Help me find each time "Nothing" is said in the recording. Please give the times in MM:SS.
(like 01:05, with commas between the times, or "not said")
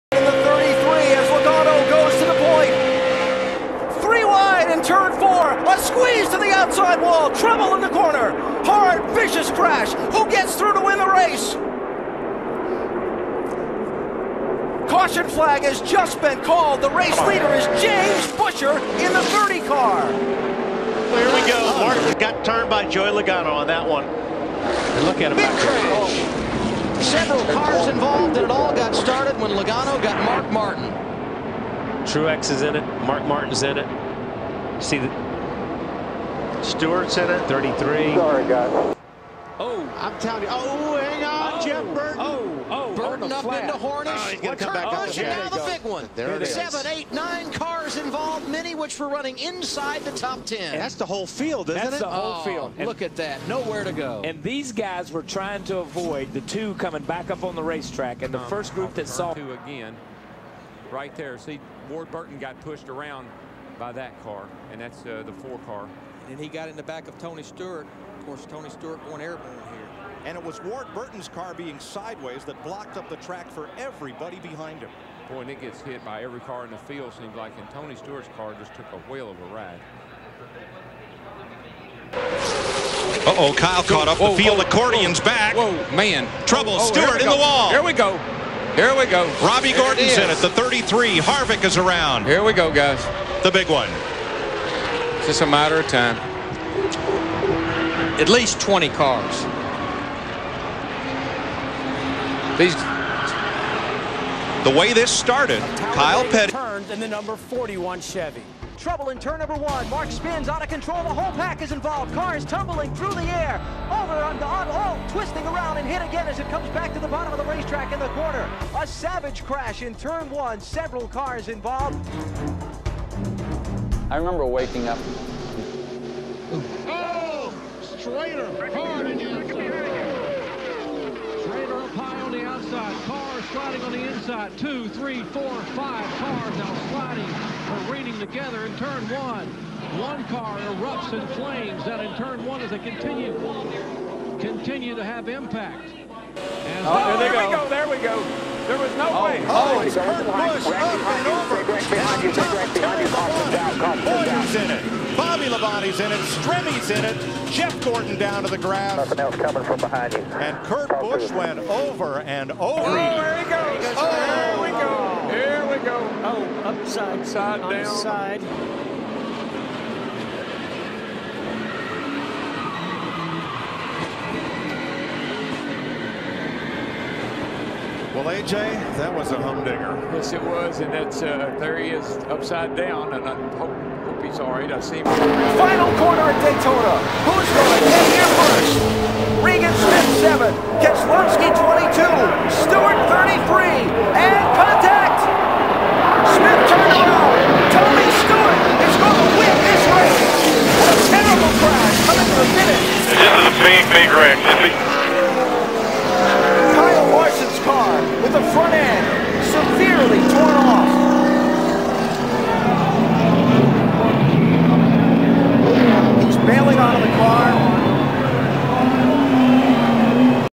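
02:38.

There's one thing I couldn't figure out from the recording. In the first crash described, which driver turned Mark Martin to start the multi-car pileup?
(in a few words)
Joey Logano.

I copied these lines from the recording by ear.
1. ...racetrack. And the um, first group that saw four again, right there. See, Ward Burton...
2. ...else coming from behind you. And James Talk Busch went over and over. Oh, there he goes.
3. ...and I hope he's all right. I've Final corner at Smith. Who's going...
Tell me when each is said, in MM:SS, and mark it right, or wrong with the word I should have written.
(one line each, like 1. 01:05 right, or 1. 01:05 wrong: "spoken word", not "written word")
1. 00:57 wrong: "two", not "four"
2. 02:39 wrong: "Kurt", not "James"
3. 03:03 wrong: "Daytona", not "Smith".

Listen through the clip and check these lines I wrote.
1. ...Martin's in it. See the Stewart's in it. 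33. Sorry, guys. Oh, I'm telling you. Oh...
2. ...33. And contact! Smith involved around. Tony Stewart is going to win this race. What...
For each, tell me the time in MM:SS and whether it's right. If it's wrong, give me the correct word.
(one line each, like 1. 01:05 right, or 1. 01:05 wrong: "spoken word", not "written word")
1. 00:33 right
2. 03:13 wrong: "turned", not "involved".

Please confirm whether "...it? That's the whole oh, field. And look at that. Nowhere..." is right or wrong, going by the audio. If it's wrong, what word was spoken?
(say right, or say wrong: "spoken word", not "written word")
right.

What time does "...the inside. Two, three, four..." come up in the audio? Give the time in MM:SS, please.
02:13.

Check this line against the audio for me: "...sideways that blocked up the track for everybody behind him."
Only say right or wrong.
right.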